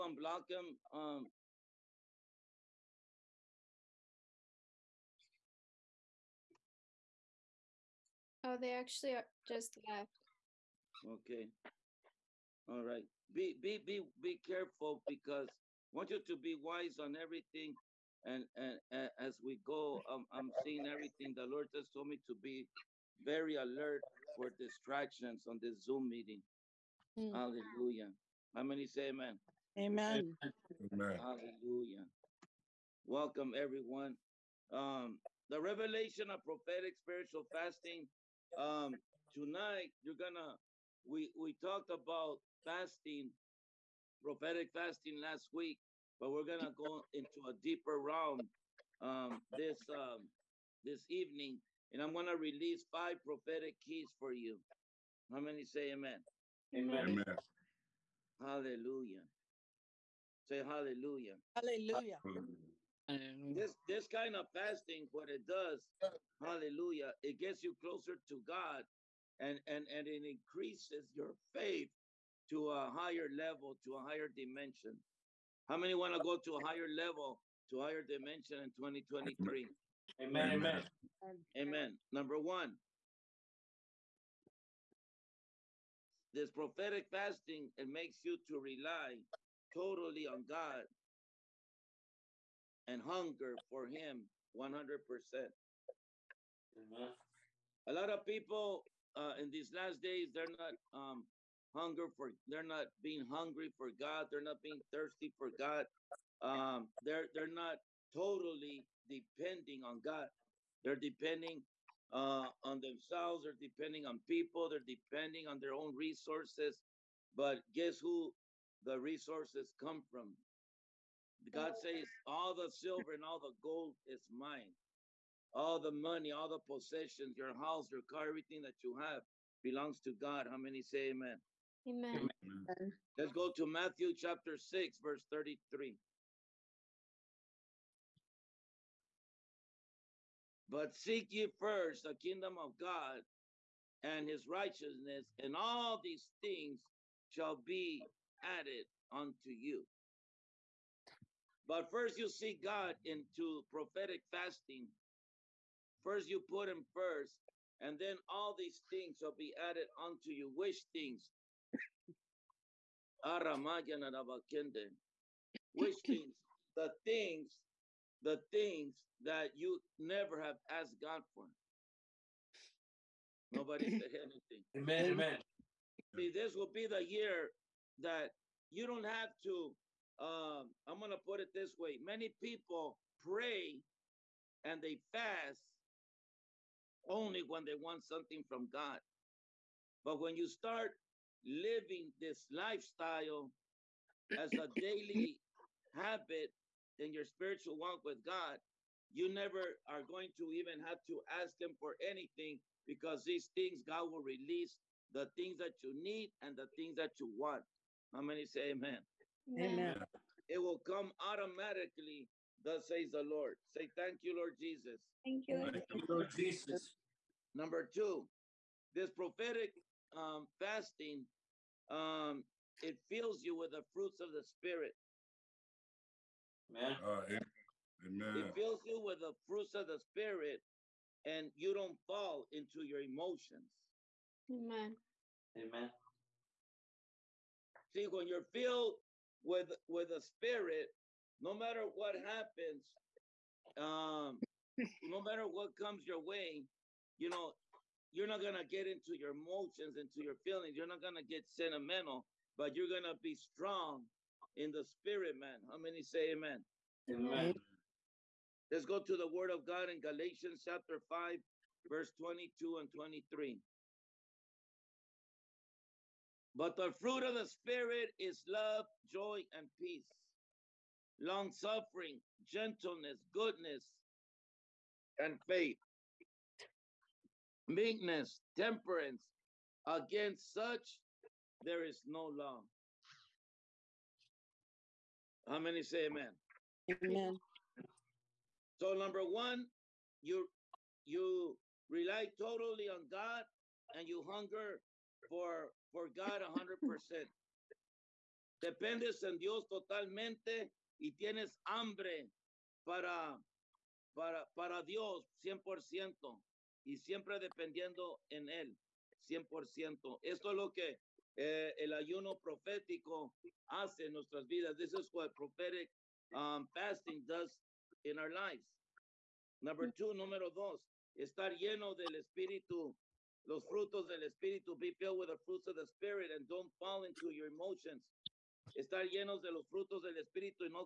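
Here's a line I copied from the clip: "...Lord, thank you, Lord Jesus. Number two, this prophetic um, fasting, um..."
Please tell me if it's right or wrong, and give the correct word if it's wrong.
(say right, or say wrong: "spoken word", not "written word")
right.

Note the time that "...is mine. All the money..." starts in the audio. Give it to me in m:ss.
2:04.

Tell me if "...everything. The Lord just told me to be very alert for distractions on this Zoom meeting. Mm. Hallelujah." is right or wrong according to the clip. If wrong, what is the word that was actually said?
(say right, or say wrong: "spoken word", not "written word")
right.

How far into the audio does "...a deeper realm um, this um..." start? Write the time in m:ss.
0:47.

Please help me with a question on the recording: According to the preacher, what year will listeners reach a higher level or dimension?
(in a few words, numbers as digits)
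2023.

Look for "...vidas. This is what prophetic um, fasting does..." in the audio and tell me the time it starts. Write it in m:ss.
5:14.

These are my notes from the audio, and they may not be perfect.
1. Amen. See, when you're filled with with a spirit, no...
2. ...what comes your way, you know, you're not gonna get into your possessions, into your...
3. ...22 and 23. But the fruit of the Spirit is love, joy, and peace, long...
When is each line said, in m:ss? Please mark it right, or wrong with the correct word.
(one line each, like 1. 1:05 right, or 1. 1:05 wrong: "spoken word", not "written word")
1. 3:55 right
2. 4:05 wrong: "emotions", not "possessions"
3. 4:22 right.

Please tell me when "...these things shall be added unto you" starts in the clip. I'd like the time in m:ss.
2:26.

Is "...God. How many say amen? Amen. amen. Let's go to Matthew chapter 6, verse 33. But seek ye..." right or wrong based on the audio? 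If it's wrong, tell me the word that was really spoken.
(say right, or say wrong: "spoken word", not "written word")
right.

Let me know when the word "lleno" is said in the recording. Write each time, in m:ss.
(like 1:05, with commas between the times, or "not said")
5:21, 5:29.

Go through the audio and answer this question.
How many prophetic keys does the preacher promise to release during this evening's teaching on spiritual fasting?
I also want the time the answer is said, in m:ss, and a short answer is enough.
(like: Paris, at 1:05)
5, at 0:52.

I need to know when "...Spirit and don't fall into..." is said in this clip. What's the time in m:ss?
5:25.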